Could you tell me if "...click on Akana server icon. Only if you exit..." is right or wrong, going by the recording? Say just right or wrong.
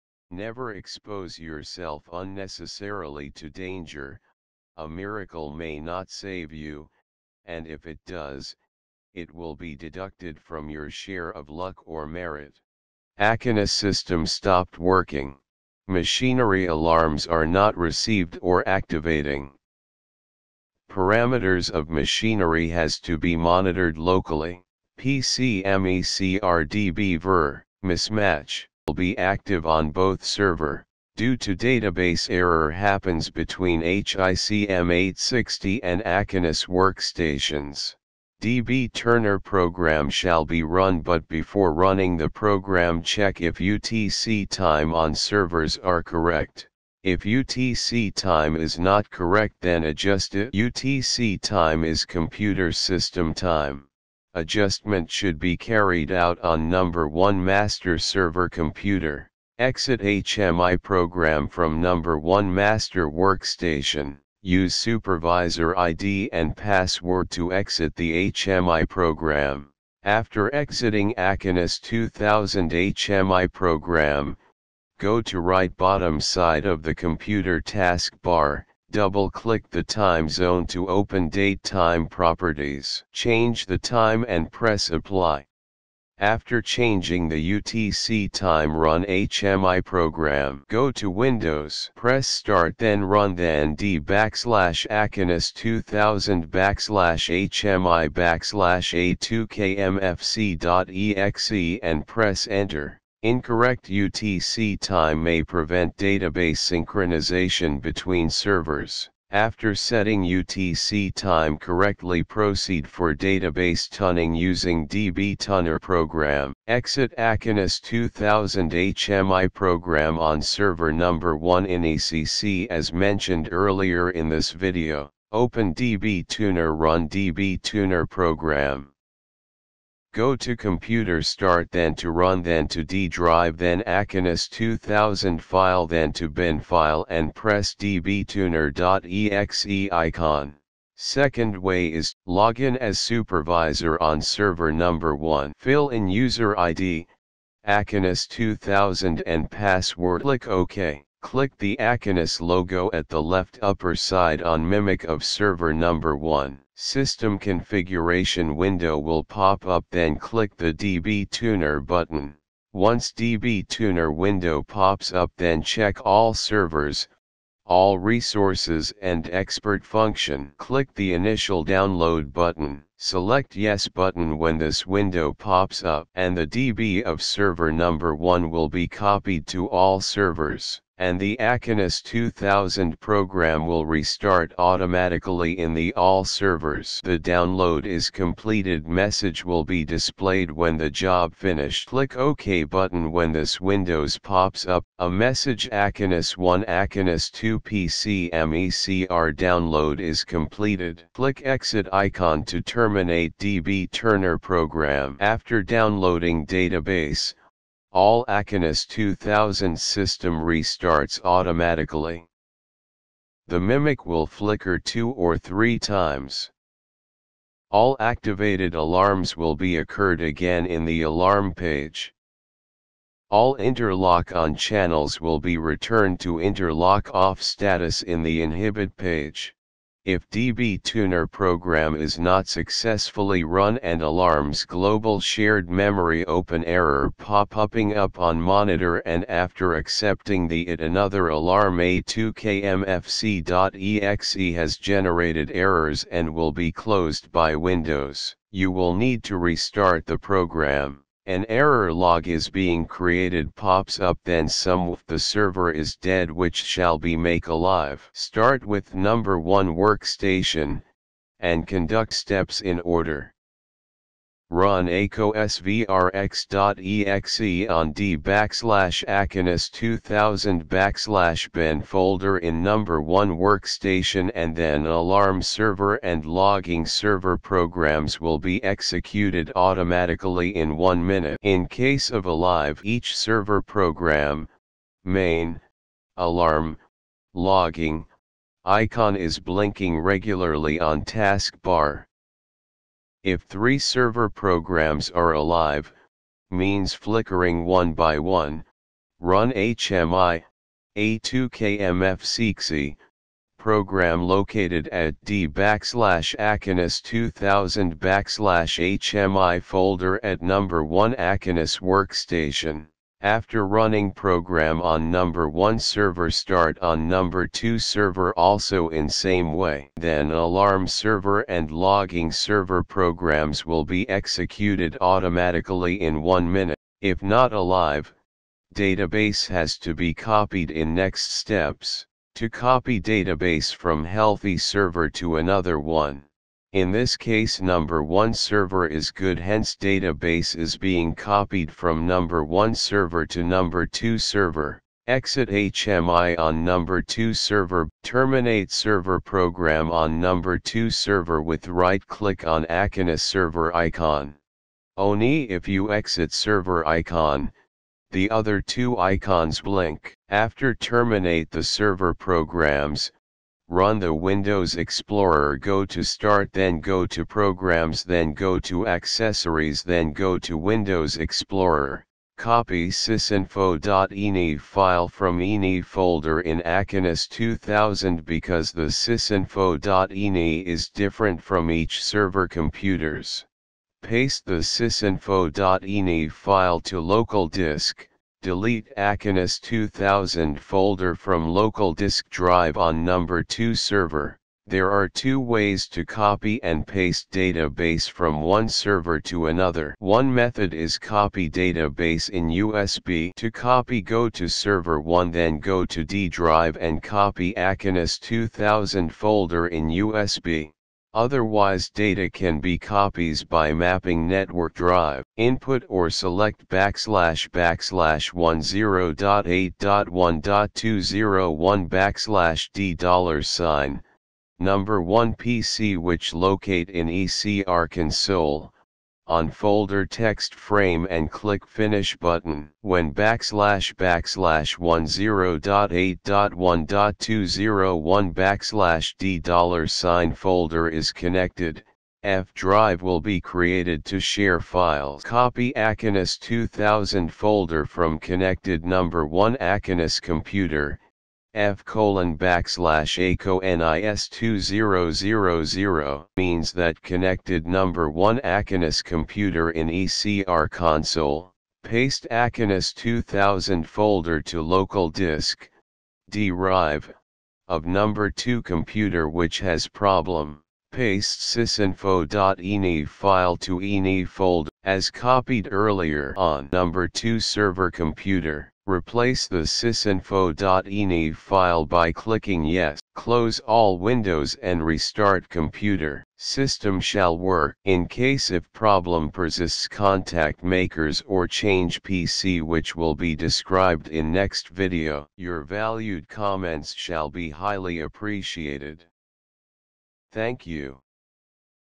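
right.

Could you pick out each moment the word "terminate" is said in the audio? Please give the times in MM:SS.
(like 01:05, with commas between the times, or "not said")
03:22, 05:48, 06:00.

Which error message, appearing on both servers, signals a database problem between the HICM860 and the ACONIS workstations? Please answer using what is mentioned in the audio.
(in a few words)
PCMECRDB ver mismatch.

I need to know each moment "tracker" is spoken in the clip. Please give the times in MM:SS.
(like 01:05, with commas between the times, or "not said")
not said.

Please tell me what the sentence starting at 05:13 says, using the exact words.
After running program on number 1 server start on number 2 server also in same way.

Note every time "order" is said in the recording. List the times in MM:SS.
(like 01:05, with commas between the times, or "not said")
04:22.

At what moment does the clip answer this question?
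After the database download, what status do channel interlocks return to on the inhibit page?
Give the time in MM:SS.
03:46.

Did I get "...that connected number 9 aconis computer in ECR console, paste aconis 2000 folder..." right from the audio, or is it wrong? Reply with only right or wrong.
wrong.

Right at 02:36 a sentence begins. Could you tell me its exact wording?
System configuration window will pop up then click the DB Tuner button.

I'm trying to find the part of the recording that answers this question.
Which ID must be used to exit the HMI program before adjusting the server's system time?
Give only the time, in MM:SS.
01:04.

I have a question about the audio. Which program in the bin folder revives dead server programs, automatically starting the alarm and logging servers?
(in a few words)
ACO_SVRX.exe.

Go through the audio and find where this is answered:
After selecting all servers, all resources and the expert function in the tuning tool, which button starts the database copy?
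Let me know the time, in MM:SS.
02:51.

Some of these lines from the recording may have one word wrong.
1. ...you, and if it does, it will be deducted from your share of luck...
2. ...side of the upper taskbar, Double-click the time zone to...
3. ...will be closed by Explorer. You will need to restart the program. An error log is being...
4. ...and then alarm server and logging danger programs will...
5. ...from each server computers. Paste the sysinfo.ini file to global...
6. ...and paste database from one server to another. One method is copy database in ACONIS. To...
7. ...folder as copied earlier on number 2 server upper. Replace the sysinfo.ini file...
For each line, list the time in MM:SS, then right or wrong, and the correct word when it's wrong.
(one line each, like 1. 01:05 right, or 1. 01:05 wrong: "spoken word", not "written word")
1. 00:06 right
2. 01:16 wrong: "computer", not "upper"
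3. 04:06 wrong: "Windows", not "Explorer"
4. 04:34 wrong: "server", not "danger"
5. 06:21 wrong: "local", not "global"
6. 06:36 wrong: "USB", not "ACONIS"
7. 07:54 wrong: "computer", not "upper".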